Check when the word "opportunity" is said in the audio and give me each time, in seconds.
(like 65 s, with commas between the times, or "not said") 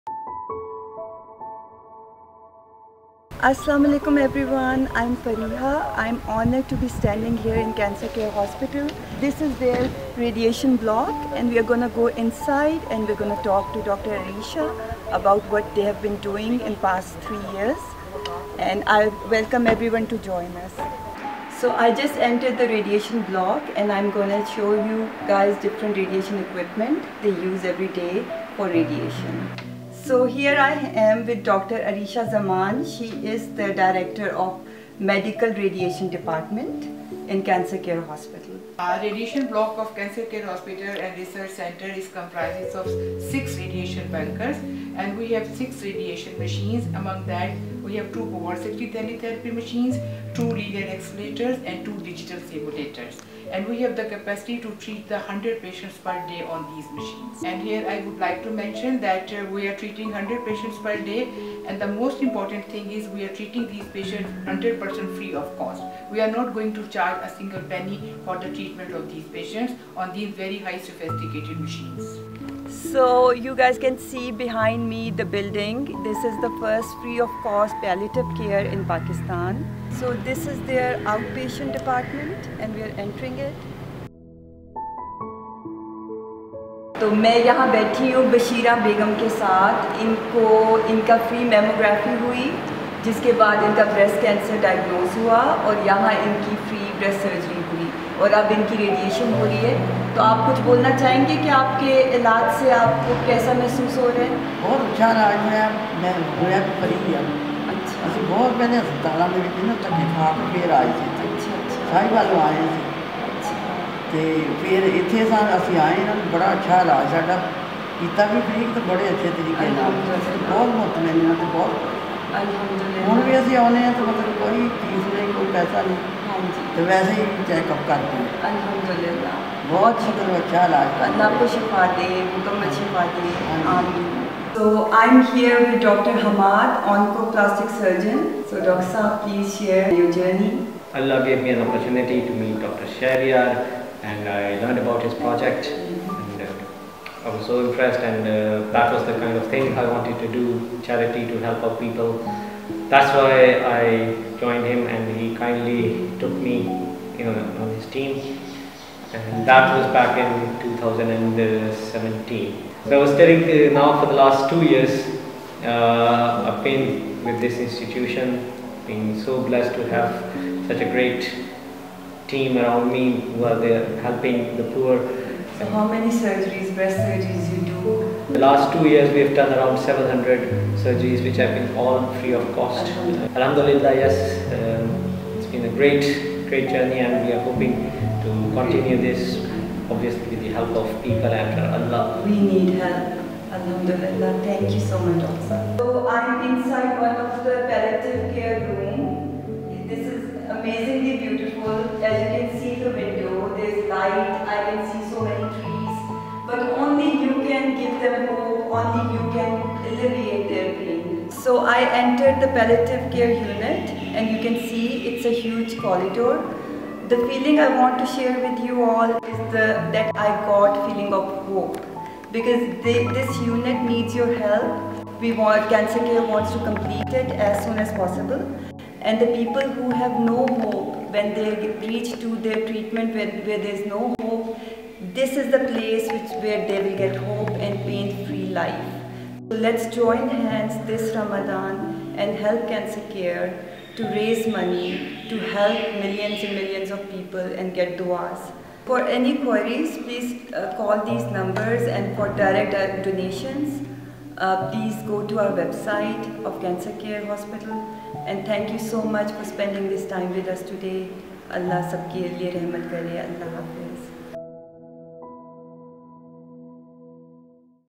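141 s.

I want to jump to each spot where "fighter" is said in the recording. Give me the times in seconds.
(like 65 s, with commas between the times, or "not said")
not said.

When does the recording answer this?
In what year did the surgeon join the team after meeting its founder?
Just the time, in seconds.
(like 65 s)
160 s.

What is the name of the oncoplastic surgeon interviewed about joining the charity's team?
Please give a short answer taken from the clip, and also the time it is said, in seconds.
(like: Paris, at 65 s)
Dr. Hamad, at 135 s.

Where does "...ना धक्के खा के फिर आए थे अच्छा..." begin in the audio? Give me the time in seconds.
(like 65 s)
109 s.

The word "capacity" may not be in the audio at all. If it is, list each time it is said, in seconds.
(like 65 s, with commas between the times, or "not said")
54 s.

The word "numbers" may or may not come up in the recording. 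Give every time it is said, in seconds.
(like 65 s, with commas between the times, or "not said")
251 s.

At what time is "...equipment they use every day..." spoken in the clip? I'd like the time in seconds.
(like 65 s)
26 s.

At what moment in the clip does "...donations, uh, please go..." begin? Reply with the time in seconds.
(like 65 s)
253 s.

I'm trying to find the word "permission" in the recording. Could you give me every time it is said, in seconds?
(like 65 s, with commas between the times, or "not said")
not said.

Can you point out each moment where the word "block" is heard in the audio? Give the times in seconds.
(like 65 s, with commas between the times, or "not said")
10 s, 23 s, 39 s.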